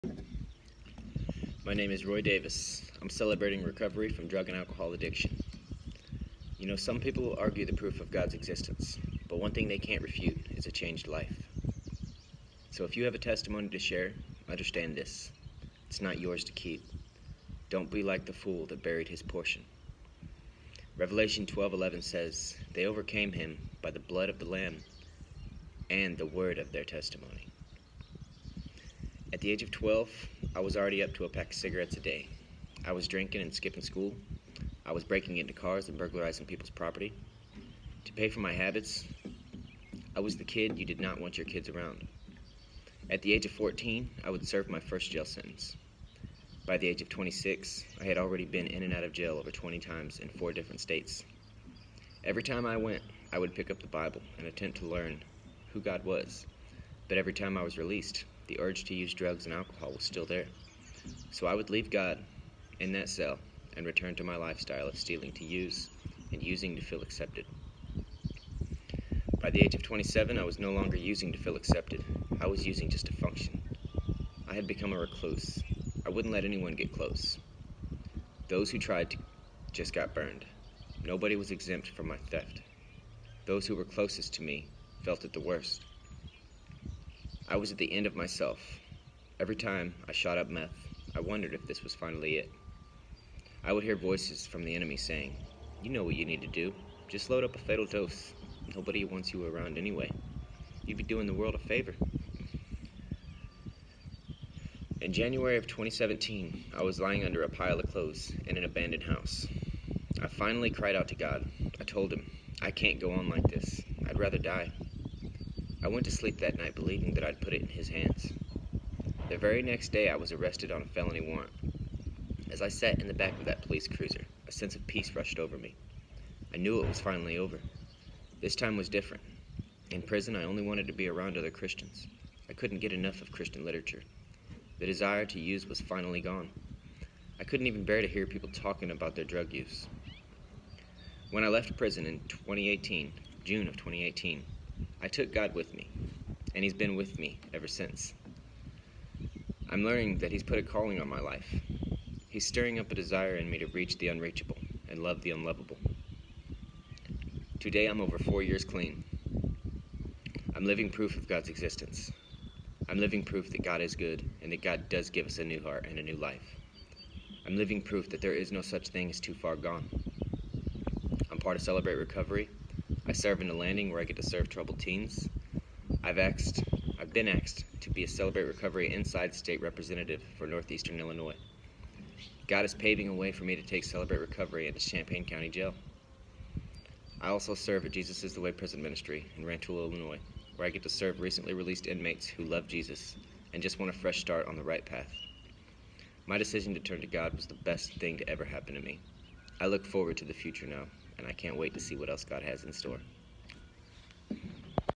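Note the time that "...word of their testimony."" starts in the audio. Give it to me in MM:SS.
00:26.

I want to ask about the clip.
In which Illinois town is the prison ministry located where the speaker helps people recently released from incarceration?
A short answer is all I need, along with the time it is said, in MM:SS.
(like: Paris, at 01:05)
Rantoul, at 03:09.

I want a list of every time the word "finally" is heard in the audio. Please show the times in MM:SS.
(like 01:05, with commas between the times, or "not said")
01:31, 01:50, 02:07, 02:15.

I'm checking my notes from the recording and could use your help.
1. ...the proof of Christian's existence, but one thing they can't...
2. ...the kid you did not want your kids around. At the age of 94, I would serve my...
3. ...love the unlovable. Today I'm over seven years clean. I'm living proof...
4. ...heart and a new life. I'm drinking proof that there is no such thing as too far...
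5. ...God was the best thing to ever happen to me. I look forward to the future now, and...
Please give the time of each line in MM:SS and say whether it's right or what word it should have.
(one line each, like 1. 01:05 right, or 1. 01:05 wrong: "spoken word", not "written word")
1. 00:07 wrong: "God", not "Christian"
2. 00:40 wrong: "14", not "94"
3. 02:35 wrong: "four", not "seven"
4. 02:45 wrong: "living", not "drinking"
5. 03:17 right.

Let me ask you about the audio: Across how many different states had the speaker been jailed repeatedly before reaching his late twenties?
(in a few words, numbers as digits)
4.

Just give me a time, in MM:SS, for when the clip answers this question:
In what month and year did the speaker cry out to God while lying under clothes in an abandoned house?
01:45.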